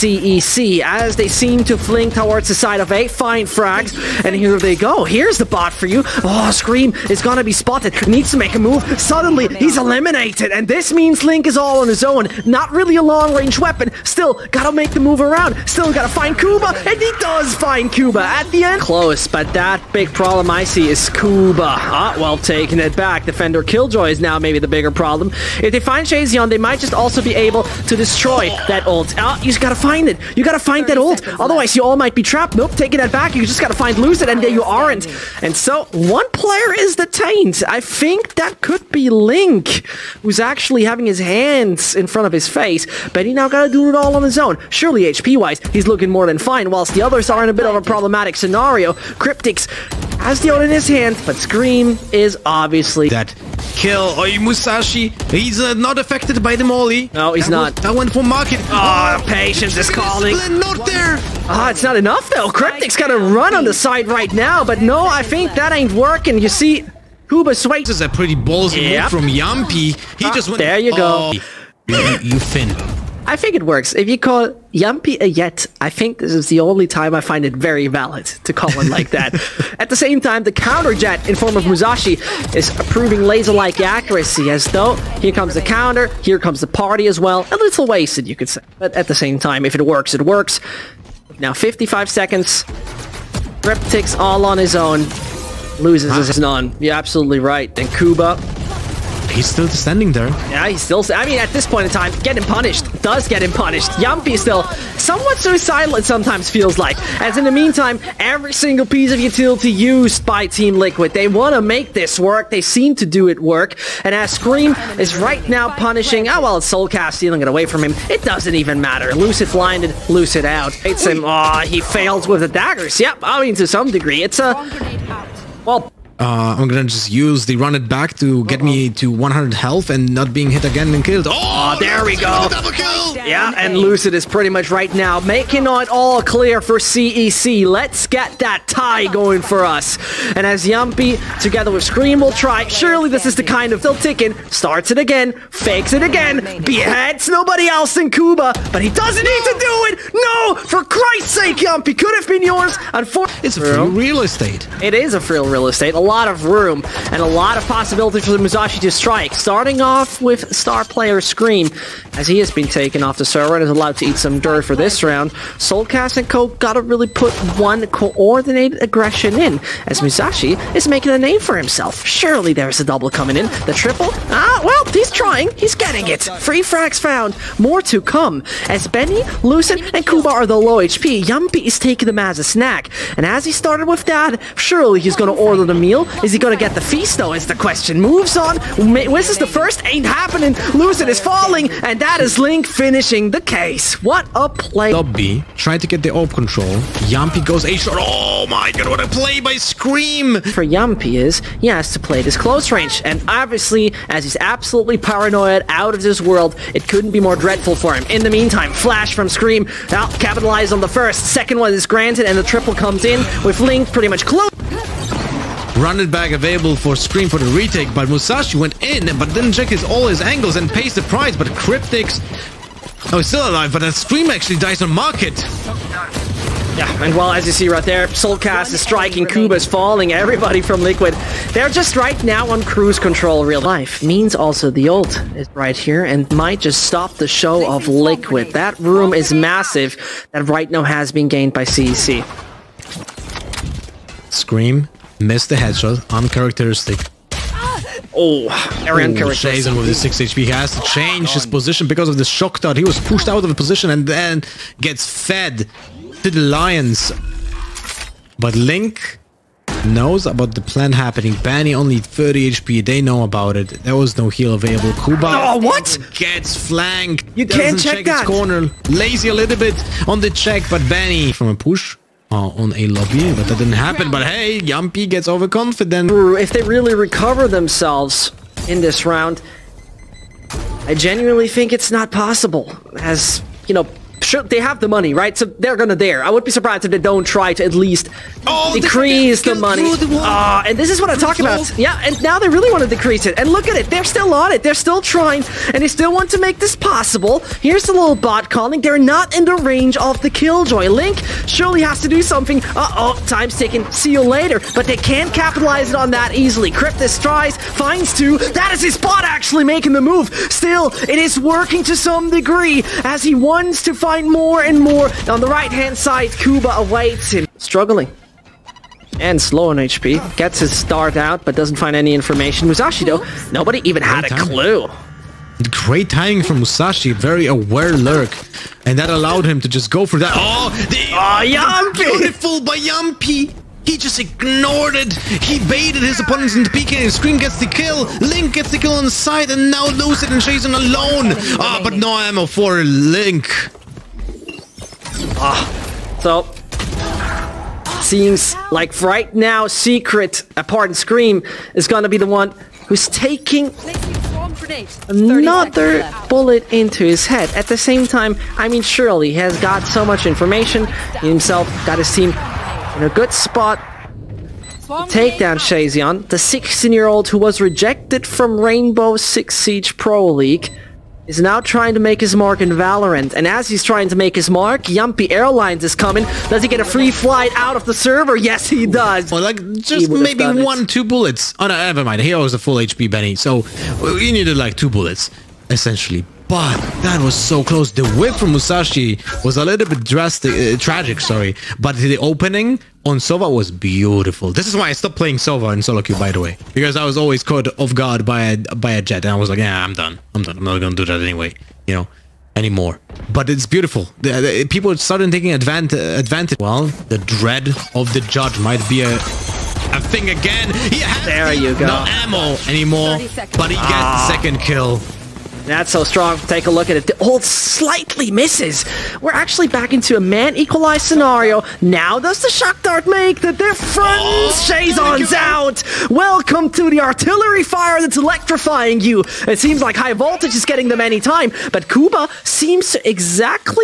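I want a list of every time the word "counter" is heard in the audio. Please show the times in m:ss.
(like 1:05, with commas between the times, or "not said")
1:20, 1:25.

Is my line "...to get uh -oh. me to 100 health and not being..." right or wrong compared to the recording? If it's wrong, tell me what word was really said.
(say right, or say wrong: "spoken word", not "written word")
right.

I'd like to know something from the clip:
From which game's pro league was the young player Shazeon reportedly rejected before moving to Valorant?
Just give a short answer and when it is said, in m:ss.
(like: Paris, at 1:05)
Rainbow Six Siege, at 6:08.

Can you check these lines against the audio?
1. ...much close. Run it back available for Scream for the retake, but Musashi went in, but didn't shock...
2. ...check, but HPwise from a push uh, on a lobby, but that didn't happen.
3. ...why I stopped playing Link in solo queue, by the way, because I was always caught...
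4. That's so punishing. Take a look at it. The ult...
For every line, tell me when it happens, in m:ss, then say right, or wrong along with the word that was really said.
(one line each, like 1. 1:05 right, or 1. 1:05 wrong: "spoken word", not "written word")
1. 3:34 wrong: "check", not "shock"
2. 4:30 wrong: "Banny", not "HPwise"
3. 6:34 wrong: "Sova", not "Link"
4. 6:55 wrong: "strong", not "punishing".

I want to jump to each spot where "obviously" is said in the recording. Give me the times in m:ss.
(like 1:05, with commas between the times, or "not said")
0:52, 3:23.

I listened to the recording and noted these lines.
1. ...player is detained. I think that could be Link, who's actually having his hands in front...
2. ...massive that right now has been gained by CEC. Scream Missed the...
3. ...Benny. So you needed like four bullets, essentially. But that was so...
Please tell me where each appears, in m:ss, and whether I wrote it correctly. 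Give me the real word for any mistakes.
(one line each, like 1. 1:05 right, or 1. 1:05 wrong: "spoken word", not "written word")
1. 0:36 right
2. 3:59 right
3. 6:23 wrong: "two", not "four".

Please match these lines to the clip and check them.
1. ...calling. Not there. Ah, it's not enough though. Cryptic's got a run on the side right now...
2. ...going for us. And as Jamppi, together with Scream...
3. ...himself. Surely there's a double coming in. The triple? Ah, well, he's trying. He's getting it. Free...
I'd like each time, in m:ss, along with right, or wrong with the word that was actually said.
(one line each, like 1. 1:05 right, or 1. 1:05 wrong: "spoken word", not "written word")
1. 0:59 right
2. 2:19 right
3. 2:51 right.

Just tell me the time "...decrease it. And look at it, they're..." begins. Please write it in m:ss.
4:52.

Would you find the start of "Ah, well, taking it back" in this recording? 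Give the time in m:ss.
0:21.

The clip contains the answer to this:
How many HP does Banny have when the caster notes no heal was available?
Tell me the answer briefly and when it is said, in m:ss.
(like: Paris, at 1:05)
30, at 4:21.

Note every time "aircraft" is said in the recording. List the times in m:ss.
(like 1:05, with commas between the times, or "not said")
not said.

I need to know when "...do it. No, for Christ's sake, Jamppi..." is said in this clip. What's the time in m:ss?
2:29.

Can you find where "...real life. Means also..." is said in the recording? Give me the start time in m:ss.
3:53.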